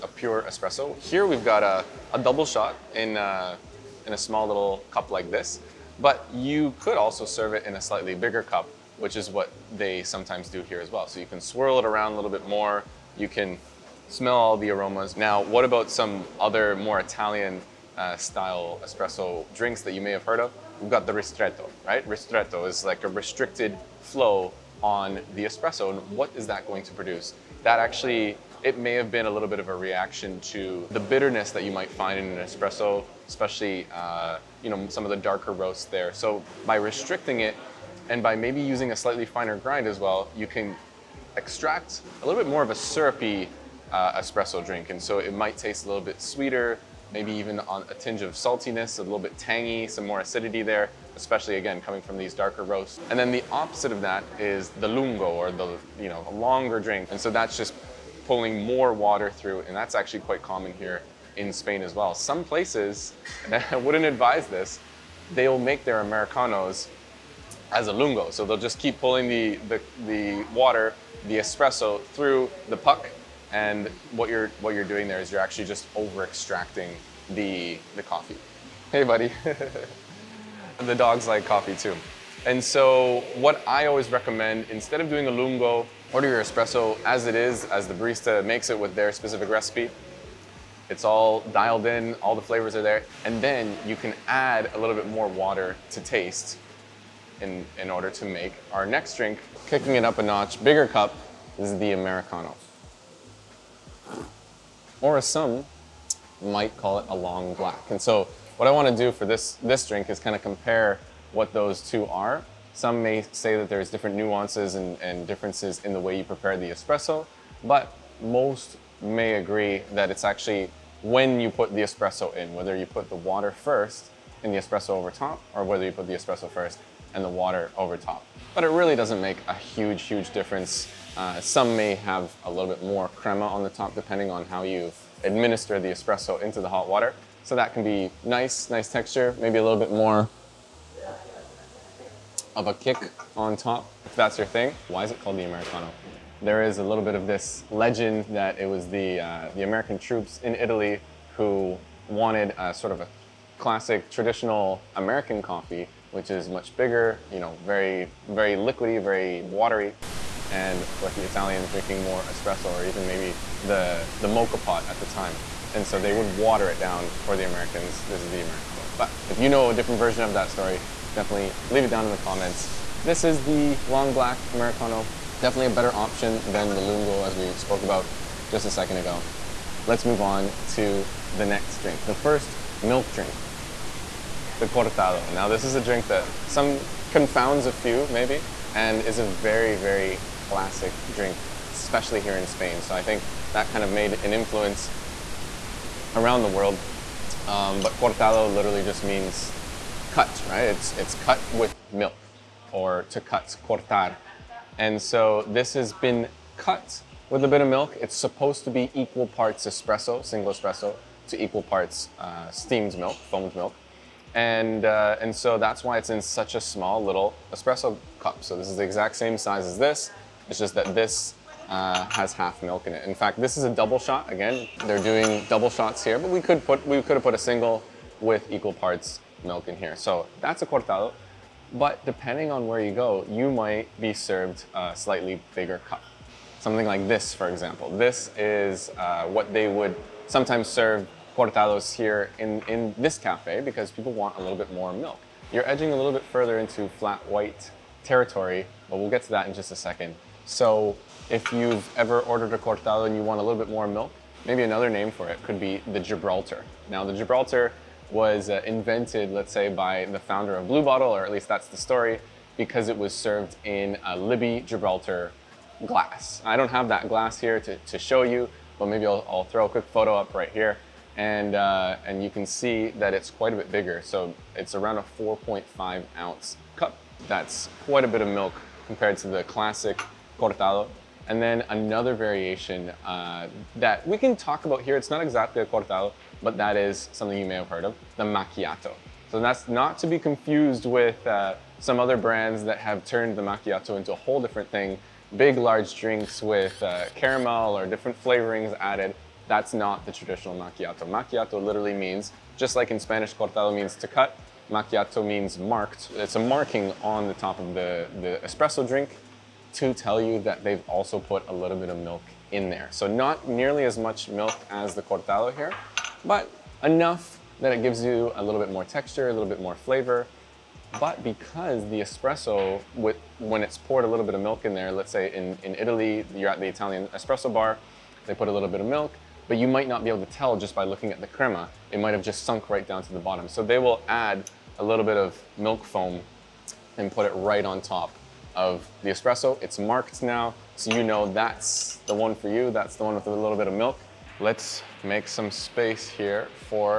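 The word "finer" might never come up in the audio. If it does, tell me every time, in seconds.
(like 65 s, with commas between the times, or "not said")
39 s.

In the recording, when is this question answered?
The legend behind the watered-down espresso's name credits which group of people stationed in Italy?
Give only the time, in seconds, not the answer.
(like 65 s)
149 s.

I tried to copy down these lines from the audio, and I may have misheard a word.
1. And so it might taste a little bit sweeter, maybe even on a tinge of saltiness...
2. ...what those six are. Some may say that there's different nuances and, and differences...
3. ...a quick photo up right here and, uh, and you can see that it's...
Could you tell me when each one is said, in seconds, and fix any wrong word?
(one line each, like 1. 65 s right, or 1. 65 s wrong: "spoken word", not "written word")
1. 44 s right
2. 111 s wrong: "two", not "six"
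3. 269 s right.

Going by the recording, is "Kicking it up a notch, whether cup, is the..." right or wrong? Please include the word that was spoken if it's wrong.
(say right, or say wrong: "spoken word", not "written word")
wrong: "bigger", not "whether".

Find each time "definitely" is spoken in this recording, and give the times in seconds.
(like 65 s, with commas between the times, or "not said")
171 s, 175 s.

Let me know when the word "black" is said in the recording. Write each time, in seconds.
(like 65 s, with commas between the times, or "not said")
107 s, 174 s.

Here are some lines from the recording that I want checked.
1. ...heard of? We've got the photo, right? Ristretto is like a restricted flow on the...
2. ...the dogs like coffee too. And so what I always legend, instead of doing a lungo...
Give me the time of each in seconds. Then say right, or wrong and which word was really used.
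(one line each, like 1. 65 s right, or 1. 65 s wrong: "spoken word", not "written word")
1. 20 s wrong: "ristretto", not "photo"
2. 80 s wrong: "recommend", not "legend".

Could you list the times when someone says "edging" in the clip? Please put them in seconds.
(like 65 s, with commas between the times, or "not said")
245 s.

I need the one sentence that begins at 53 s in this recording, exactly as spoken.
And then the opposite of that is the lungo or the, you know, longer drink.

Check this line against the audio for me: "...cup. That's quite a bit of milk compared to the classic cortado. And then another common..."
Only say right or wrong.
wrong.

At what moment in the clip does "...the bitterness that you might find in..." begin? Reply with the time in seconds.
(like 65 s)
30 s.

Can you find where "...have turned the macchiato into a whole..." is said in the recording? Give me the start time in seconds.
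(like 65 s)
292 s.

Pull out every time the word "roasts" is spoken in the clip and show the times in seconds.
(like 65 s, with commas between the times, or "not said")
35 s, 52 s.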